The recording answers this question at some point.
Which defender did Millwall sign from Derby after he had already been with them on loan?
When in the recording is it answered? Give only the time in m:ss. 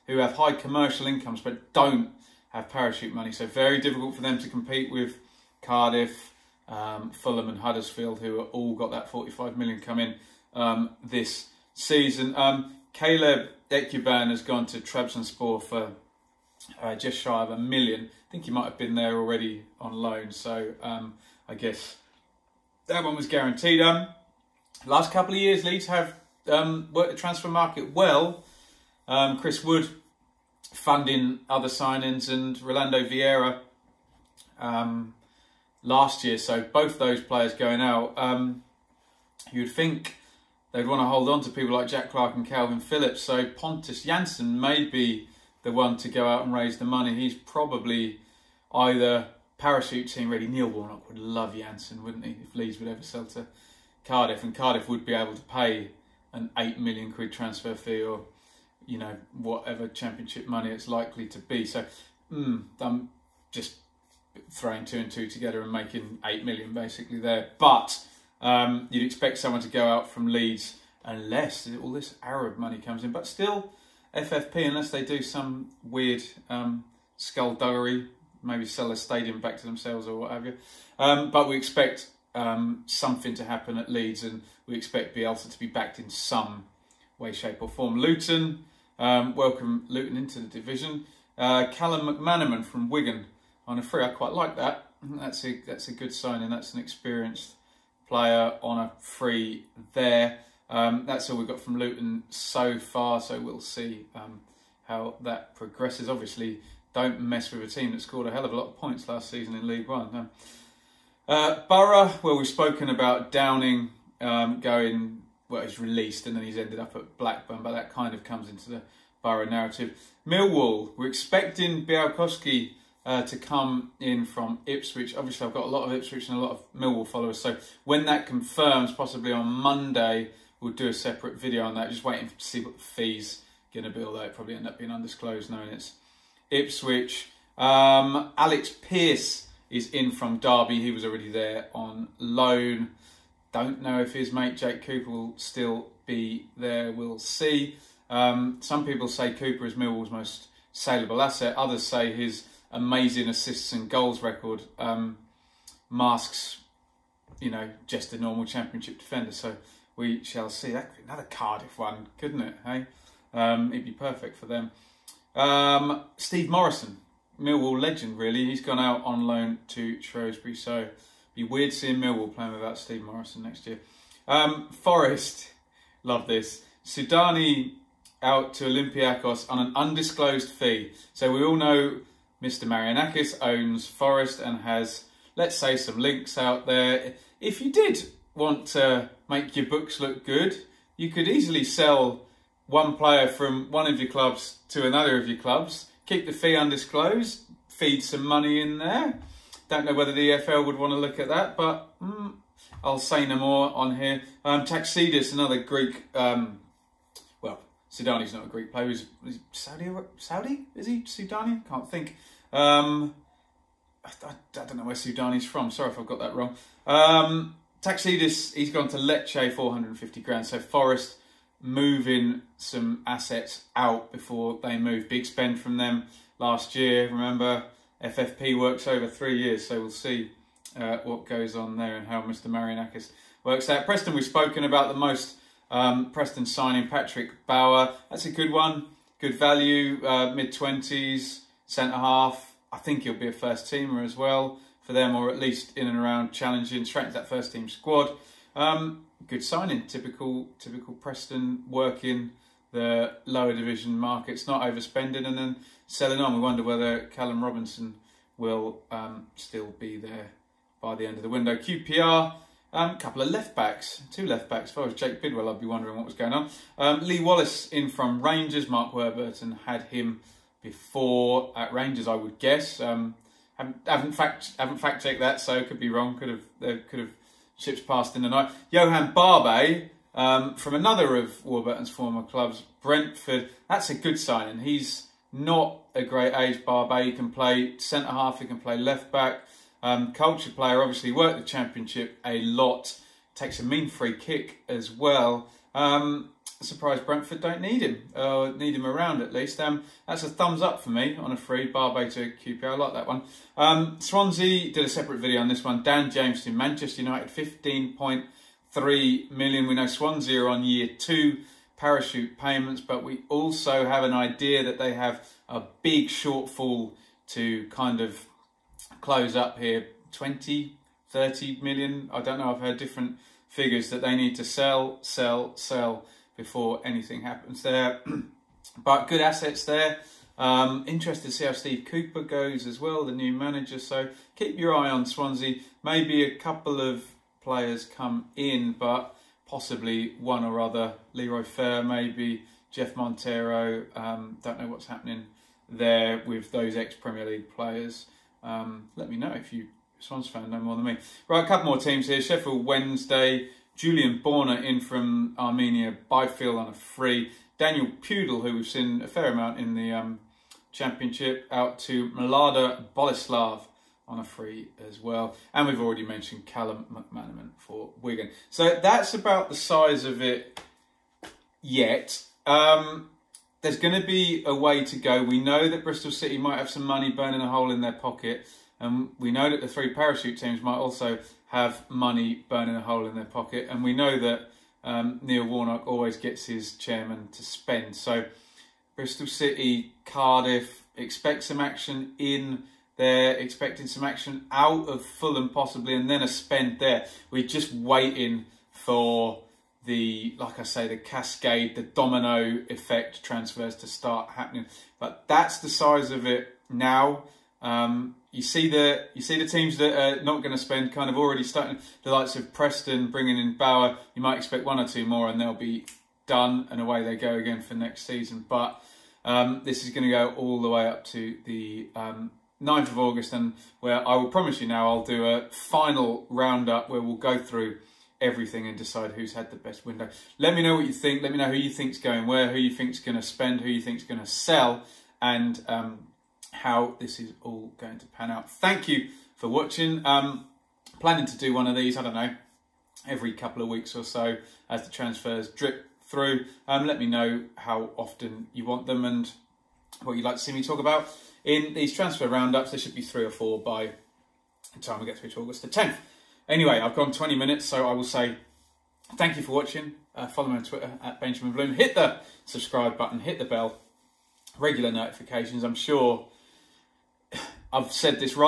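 2:18.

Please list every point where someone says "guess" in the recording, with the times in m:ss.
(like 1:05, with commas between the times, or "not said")
0:21, 4:32.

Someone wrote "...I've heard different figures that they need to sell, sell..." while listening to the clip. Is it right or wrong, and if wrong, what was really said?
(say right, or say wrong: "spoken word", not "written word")
right.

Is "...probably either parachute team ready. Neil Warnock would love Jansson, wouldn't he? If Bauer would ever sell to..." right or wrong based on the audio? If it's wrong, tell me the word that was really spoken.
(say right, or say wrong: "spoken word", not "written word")
wrong: "Leeds", not "Bauer".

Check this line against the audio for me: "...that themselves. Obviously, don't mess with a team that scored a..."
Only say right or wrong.
wrong.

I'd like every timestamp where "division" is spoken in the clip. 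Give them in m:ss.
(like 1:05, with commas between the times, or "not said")
1:30, 4:13.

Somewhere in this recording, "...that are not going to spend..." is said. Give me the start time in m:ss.
6:49.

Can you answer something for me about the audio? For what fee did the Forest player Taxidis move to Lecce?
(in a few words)
450 grand.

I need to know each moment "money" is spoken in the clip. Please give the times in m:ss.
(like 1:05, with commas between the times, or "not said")
0:03, 0:46, 1:00, 1:12, 3:18, 6:16, 6:21.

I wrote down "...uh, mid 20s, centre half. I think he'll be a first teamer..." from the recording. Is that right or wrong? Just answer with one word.
right.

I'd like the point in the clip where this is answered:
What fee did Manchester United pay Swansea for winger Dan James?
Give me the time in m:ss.
5:07.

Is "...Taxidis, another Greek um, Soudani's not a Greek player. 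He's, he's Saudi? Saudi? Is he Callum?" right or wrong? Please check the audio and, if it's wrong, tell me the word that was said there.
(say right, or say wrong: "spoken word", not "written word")
wrong: "Soudani", not "Callum".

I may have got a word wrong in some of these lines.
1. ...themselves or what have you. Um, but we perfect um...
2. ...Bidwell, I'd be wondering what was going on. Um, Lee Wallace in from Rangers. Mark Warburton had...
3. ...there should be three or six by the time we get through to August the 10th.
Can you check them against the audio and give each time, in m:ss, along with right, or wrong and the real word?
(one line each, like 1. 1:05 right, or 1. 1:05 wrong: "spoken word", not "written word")
1. 1:19 wrong: "expect", not "perfect"
2. 4:25 right
3. 7:32 wrong: "four", not "six".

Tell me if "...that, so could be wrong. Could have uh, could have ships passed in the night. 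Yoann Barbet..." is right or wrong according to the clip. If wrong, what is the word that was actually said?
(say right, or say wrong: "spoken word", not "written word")
right.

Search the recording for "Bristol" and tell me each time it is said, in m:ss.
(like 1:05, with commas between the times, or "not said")
6:15, 6:28.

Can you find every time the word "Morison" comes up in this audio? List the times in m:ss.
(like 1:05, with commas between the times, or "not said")
2:46, 2:53.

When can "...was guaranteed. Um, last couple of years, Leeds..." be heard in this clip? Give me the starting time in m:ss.
0:23.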